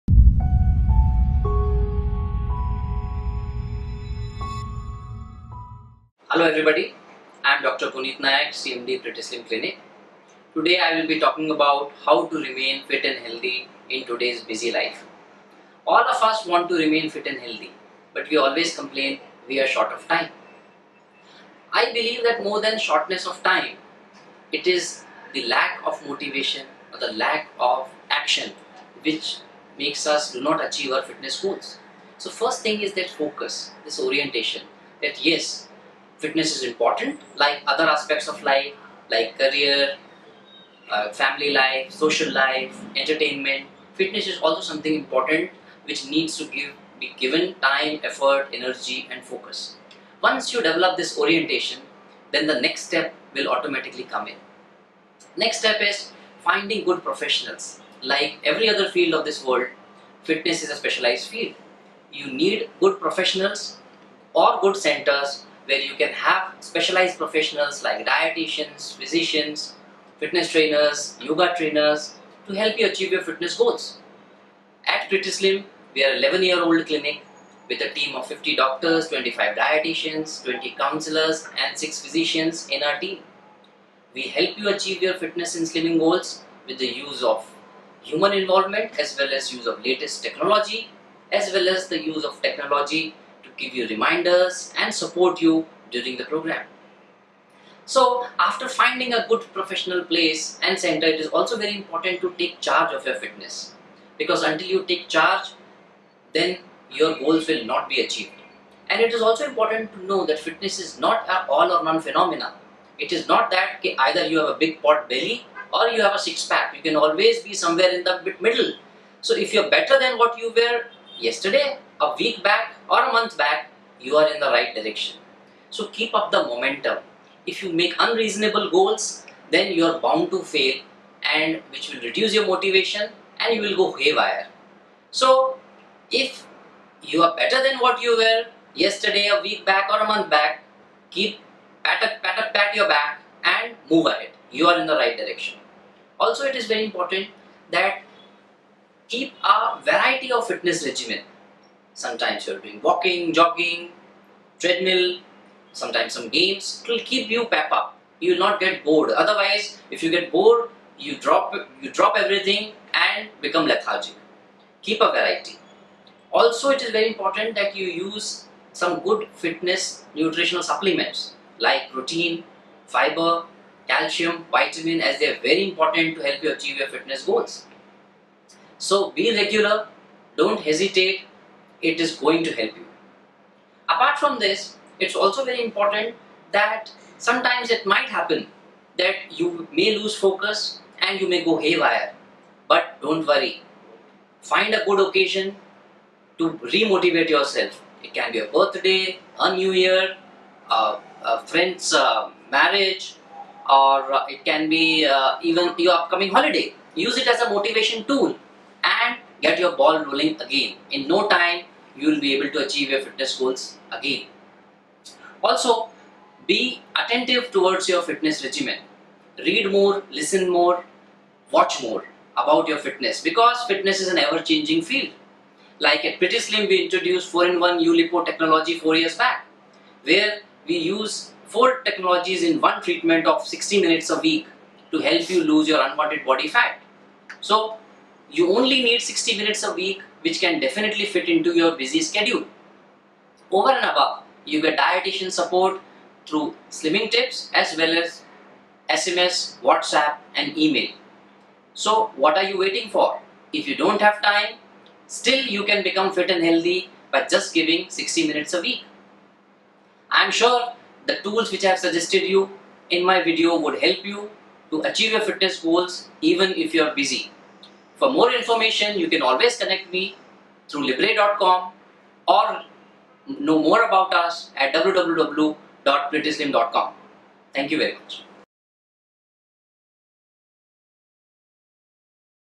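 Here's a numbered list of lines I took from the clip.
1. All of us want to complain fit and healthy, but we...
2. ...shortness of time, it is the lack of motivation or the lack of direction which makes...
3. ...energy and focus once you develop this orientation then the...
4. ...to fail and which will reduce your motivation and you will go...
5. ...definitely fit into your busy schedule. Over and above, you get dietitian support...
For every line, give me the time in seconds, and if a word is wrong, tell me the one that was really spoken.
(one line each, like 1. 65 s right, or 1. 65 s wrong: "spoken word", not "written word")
1. 15 s wrong: "remain", not "complain"
2. 22 s wrong: "action", not "direction"
3. 48 s right
4. 130 s right
5. 240 s right.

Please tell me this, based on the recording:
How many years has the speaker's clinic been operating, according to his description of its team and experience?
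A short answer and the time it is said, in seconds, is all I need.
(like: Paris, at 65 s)
11, at 76 s.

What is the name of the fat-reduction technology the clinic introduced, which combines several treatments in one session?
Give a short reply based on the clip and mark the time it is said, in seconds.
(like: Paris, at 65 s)
4-in-1 ULipo, at 227 s.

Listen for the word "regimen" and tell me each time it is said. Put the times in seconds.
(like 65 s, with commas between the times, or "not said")
150 s, 218 s.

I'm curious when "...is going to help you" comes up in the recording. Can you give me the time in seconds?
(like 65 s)
181 s.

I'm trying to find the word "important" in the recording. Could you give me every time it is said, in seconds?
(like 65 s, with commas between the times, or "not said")
36 s, 45 s, 101 s, 109 s, 146 s, 167 s, 175 s, 185 s.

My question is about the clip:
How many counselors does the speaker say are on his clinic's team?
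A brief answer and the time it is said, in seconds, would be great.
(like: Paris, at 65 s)
20, at 80 s.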